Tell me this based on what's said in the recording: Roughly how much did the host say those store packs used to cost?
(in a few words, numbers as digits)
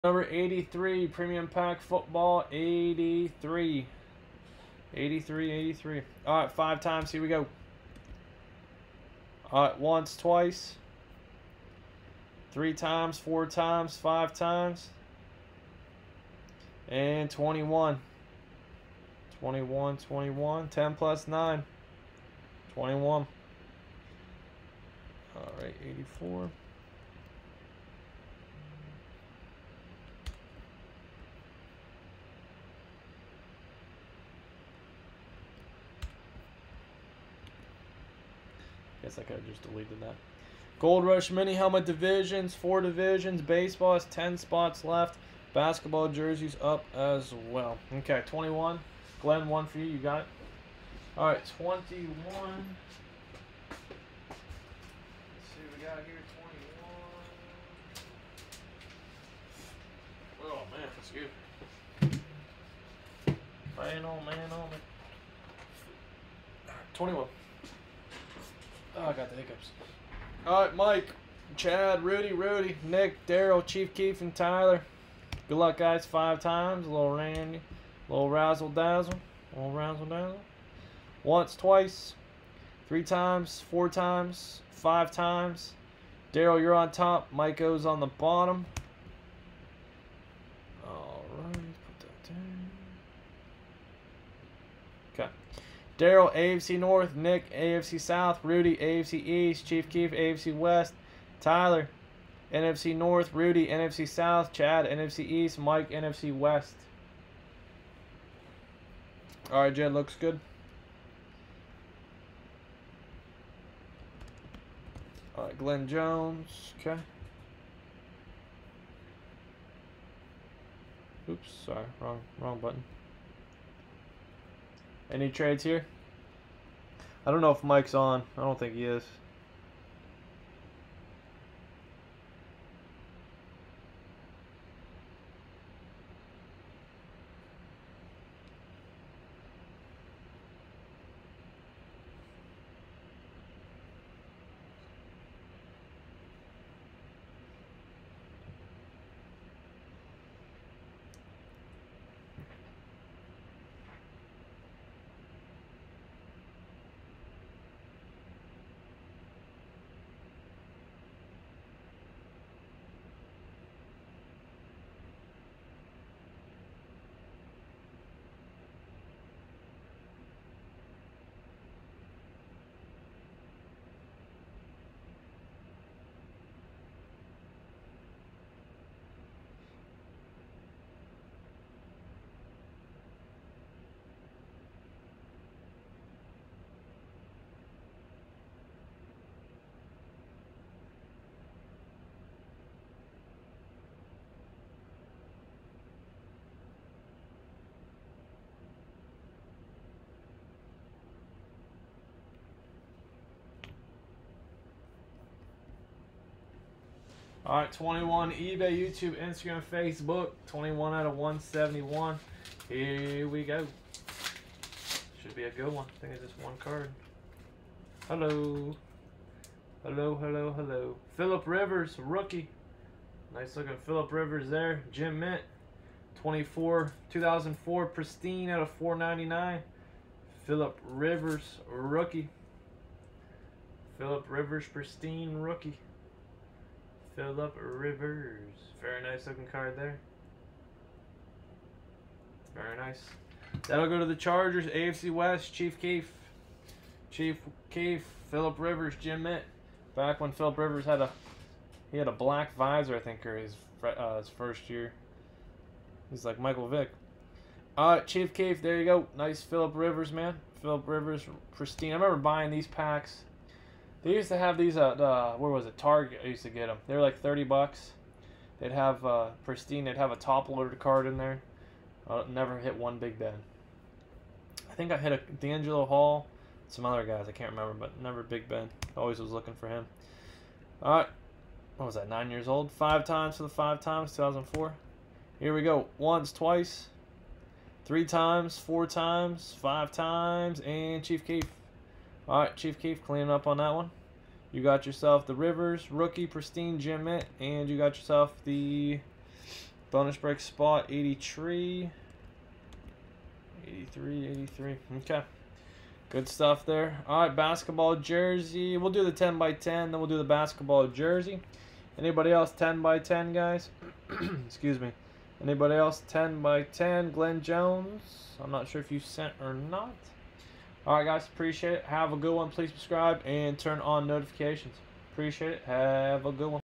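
30 dollars.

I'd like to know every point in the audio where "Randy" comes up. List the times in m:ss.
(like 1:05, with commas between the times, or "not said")
1:17.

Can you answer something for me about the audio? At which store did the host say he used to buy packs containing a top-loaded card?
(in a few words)
Target.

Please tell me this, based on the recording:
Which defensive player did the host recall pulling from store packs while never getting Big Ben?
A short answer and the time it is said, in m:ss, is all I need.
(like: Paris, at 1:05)
DeAngelo Hall, at 4:35.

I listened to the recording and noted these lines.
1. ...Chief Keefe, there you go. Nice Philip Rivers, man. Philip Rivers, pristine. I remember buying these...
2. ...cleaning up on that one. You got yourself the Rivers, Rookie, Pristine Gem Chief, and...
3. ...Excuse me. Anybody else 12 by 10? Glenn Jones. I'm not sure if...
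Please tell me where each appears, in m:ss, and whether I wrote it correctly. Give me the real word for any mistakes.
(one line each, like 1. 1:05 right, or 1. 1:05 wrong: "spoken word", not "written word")
1. 4:17 right
2. 4:53 wrong: "Mint", not "Chief"
3. 5:14 wrong: "10", not "12".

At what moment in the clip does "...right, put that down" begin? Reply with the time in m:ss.
1:31.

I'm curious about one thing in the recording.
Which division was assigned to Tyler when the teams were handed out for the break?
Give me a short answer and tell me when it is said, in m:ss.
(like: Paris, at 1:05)
NFC North, at 1:42.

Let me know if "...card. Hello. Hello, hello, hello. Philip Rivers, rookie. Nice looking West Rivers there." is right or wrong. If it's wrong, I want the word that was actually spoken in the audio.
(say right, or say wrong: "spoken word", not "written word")
wrong: "Philip", not "West".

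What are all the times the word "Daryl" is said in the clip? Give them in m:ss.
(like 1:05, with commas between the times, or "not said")
1:13, 1:26, 1:36.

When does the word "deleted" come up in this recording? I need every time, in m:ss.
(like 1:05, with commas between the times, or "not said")
0:39.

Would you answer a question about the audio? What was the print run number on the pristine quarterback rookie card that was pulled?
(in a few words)
499.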